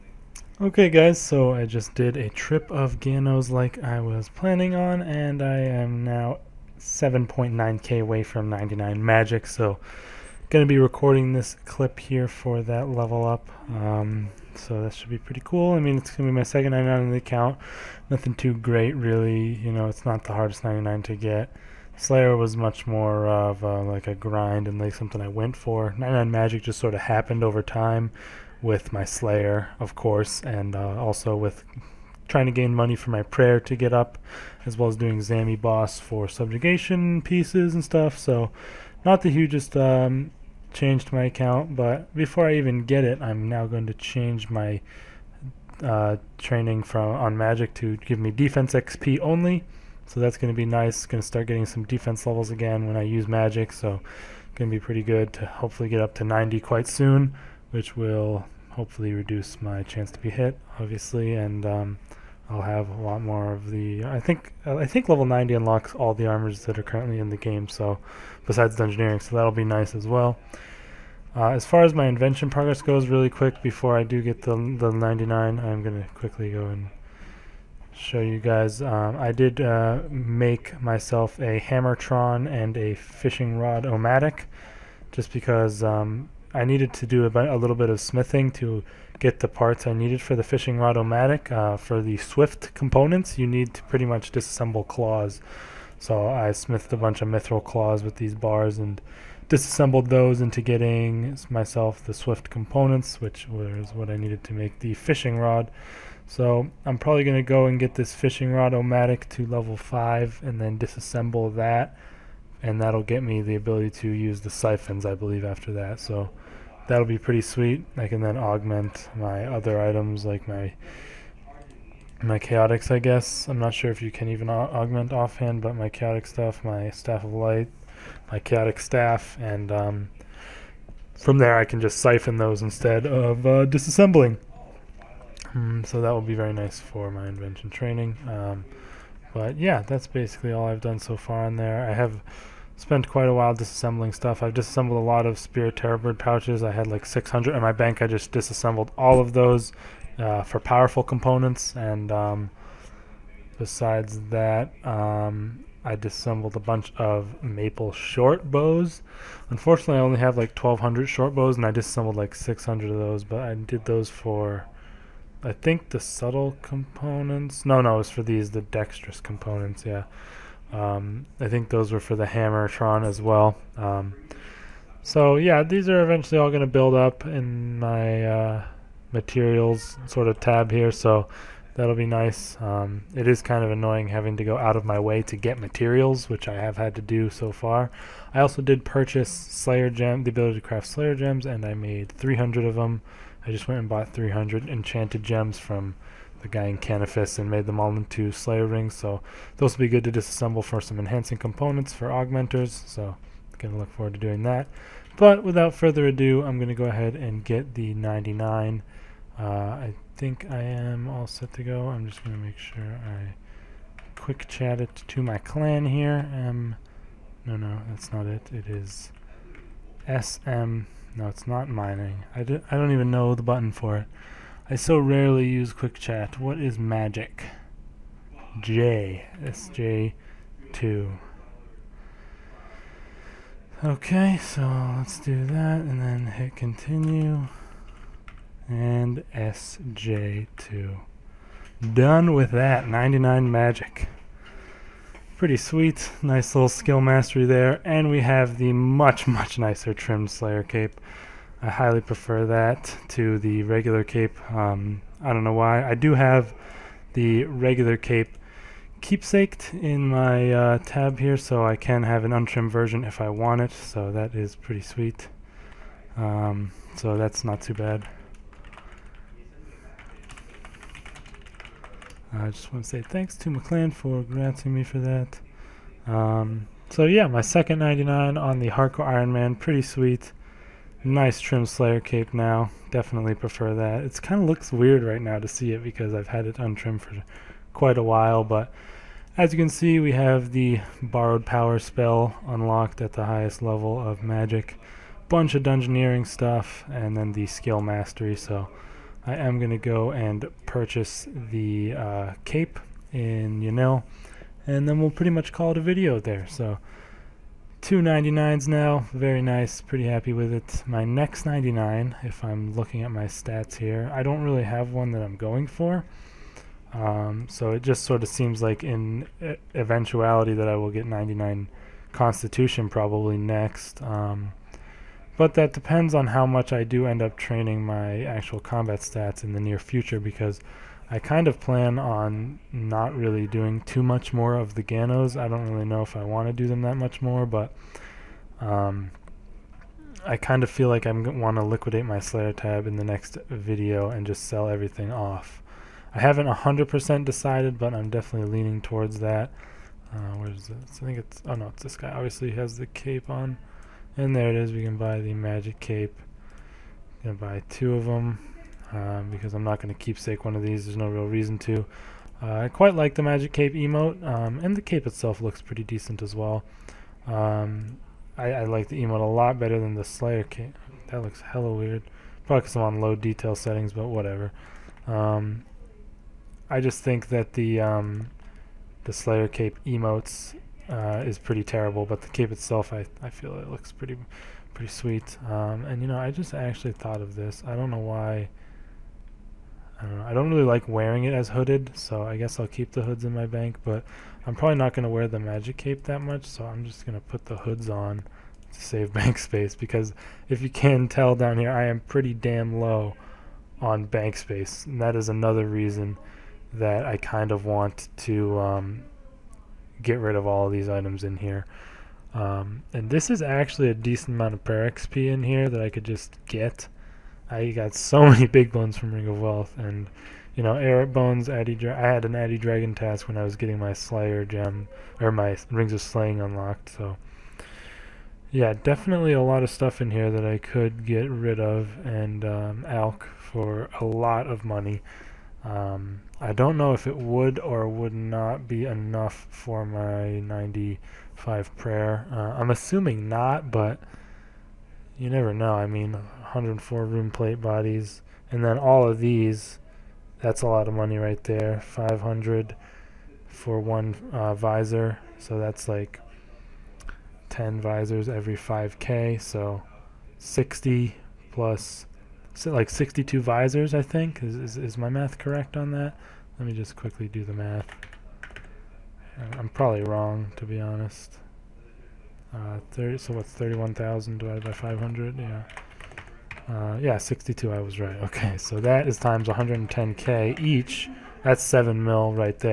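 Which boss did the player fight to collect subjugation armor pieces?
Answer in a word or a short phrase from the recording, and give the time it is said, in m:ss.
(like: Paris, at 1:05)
Zami Boss, at 0:35.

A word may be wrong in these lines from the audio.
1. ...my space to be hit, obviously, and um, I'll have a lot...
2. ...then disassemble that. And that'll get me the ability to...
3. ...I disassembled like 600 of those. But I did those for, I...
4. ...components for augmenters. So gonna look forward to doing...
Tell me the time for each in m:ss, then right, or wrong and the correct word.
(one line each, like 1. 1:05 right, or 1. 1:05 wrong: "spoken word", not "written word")
1. 0:59 wrong: "chance", not "space"
2. 1:50 right
3. 2:41 right
4. 3:21 right.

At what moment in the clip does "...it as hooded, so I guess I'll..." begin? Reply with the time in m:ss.
6:31.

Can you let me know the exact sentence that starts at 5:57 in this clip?
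Gonna buy two of them um, because I'm not going to keepsake one of these.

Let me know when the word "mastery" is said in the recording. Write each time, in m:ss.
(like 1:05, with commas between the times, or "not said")
4:07, 4:57.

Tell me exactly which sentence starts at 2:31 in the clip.
And um, besides that, um, I disassembled a bunch of maple short bows.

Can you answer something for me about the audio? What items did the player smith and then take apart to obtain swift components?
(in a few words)
mithril claws.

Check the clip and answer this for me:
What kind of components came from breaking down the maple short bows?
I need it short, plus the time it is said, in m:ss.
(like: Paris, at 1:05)
dexterous components, at 2:48.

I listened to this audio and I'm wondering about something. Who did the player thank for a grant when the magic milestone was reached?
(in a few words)
McLean.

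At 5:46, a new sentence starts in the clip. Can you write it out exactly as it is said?
I haven't 100% decided, but I'm definitely leaning towards that.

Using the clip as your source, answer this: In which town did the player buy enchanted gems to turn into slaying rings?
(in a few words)
Canifis.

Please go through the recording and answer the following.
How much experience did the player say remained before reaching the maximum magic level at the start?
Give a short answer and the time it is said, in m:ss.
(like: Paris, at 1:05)
7.9k, at 0:06.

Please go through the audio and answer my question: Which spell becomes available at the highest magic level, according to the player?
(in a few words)
Borrowed Power.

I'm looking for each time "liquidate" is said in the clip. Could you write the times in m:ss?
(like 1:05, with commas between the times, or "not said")
5:41.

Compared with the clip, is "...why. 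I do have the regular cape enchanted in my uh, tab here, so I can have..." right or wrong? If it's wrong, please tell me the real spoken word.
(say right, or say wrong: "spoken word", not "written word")
wrong: "keepsaked", not "enchanted".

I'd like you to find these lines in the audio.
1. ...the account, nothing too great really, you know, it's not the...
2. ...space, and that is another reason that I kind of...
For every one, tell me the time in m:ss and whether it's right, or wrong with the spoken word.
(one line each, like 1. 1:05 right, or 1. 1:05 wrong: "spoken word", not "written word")
1. 0:17 right
2. 6:44 right.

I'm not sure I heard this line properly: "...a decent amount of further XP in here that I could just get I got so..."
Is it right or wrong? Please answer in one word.
wrong.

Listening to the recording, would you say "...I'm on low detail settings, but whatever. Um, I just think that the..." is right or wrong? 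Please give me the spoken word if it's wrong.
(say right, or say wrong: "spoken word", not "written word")
right.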